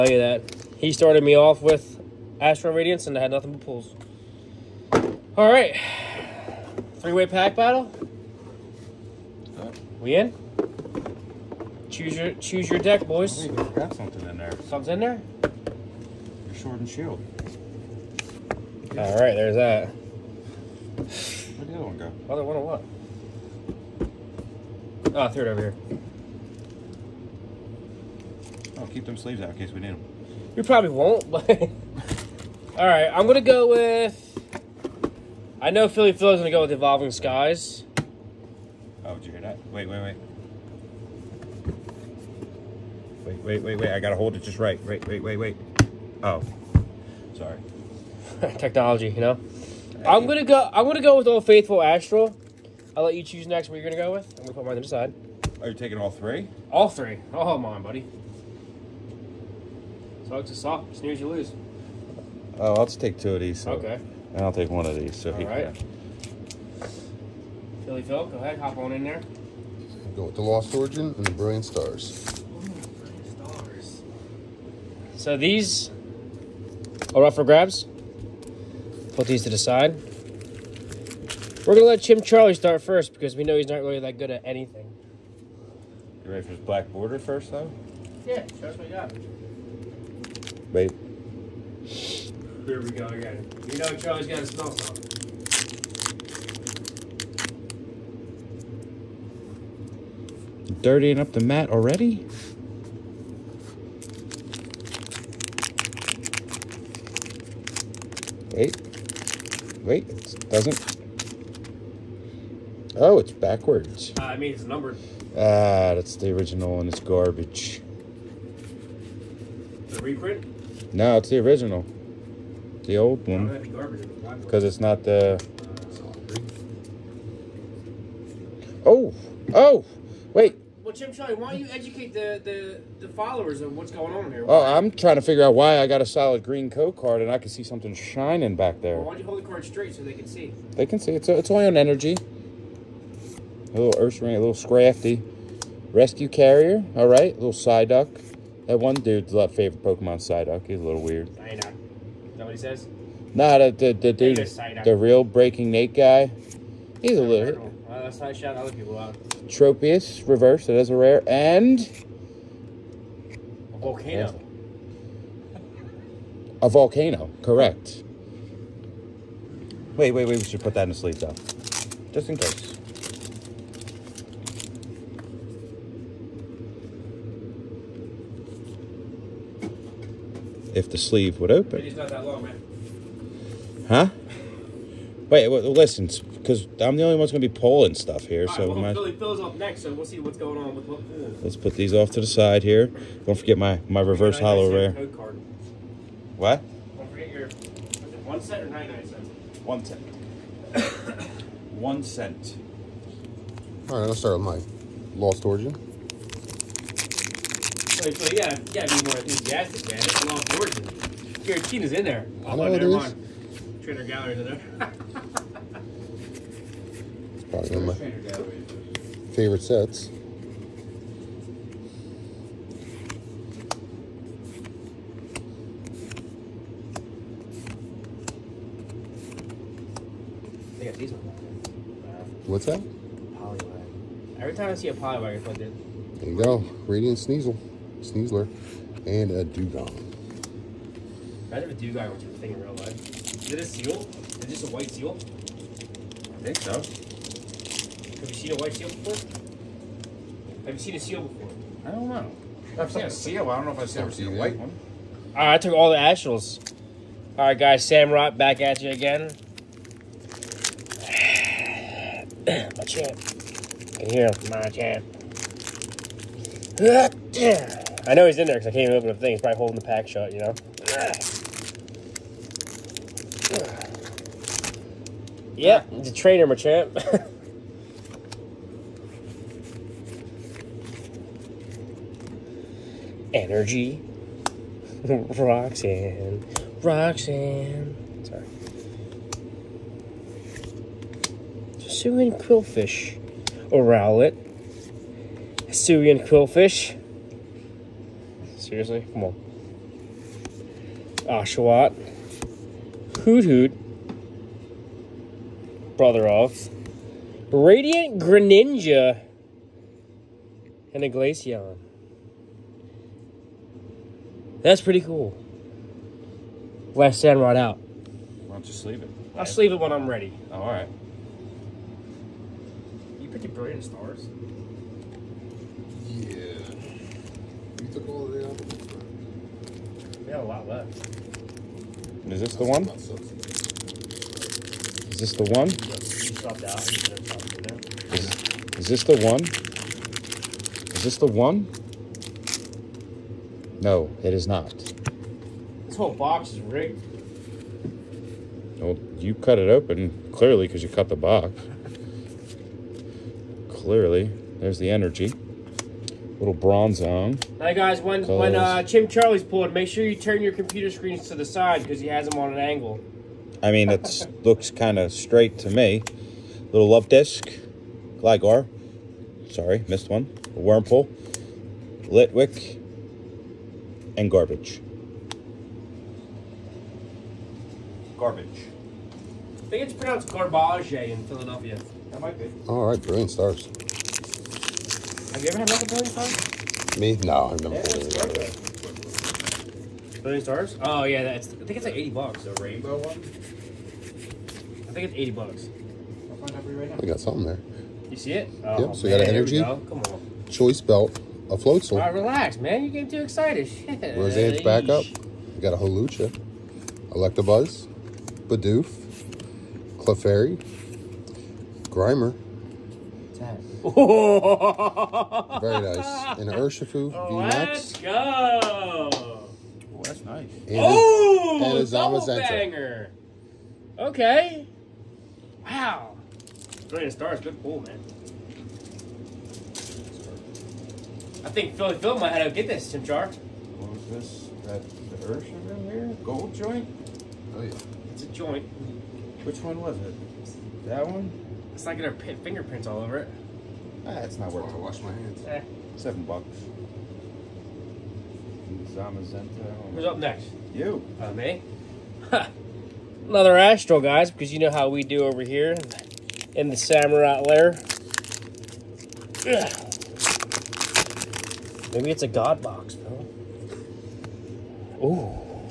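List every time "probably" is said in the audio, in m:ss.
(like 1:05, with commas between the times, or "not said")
0:30, 3:37, 4:29.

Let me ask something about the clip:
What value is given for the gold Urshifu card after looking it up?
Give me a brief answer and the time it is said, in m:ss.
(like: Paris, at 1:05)
$7, at 7:25.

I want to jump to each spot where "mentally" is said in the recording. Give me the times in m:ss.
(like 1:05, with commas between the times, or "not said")
not said.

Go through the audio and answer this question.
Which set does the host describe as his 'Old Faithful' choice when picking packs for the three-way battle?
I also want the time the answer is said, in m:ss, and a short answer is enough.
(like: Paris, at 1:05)
Astral Radiance, at 0:51.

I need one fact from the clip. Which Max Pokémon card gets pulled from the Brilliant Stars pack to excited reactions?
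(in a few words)
Urshifu Max.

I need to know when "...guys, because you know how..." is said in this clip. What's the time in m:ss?
7:33.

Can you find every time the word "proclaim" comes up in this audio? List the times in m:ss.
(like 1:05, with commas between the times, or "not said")
not said.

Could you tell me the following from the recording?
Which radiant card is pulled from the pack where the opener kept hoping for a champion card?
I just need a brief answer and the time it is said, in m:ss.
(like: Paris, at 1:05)
Radiant Greninja, at 5:07.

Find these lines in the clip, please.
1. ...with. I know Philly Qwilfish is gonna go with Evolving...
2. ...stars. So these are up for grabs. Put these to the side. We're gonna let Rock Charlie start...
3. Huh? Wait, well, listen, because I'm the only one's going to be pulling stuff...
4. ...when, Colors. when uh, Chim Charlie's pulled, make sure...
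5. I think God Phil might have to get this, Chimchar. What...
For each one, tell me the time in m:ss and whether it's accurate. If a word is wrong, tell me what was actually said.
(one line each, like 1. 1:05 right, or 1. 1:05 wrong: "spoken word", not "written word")
1. 0:33 wrong: "Phil", not "Qwilfish"
2. 1:13 wrong: "Chim", not "Rock"
3. 3:03 right
4. 5:57 right
5. 7:11 wrong: "Philly", not "God".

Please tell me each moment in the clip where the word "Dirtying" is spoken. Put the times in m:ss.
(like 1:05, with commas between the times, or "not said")
1:40.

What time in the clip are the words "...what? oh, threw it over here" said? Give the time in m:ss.
0:22.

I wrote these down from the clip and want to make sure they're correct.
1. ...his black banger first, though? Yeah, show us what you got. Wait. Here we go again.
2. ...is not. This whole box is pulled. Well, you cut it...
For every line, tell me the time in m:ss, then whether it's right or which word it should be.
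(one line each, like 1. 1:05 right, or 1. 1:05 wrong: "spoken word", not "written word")
1. 1:26 wrong: "border", not "banger"
2. 5:44 wrong: "rigged", not "pulled".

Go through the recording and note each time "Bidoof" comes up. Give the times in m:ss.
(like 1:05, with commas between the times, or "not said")
6:48.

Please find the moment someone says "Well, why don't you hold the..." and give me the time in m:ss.
2:18.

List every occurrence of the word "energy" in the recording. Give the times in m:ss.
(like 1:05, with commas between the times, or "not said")
2:21, 4:43, 5:54, 6:39.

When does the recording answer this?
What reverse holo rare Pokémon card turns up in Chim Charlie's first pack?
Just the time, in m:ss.
2:39.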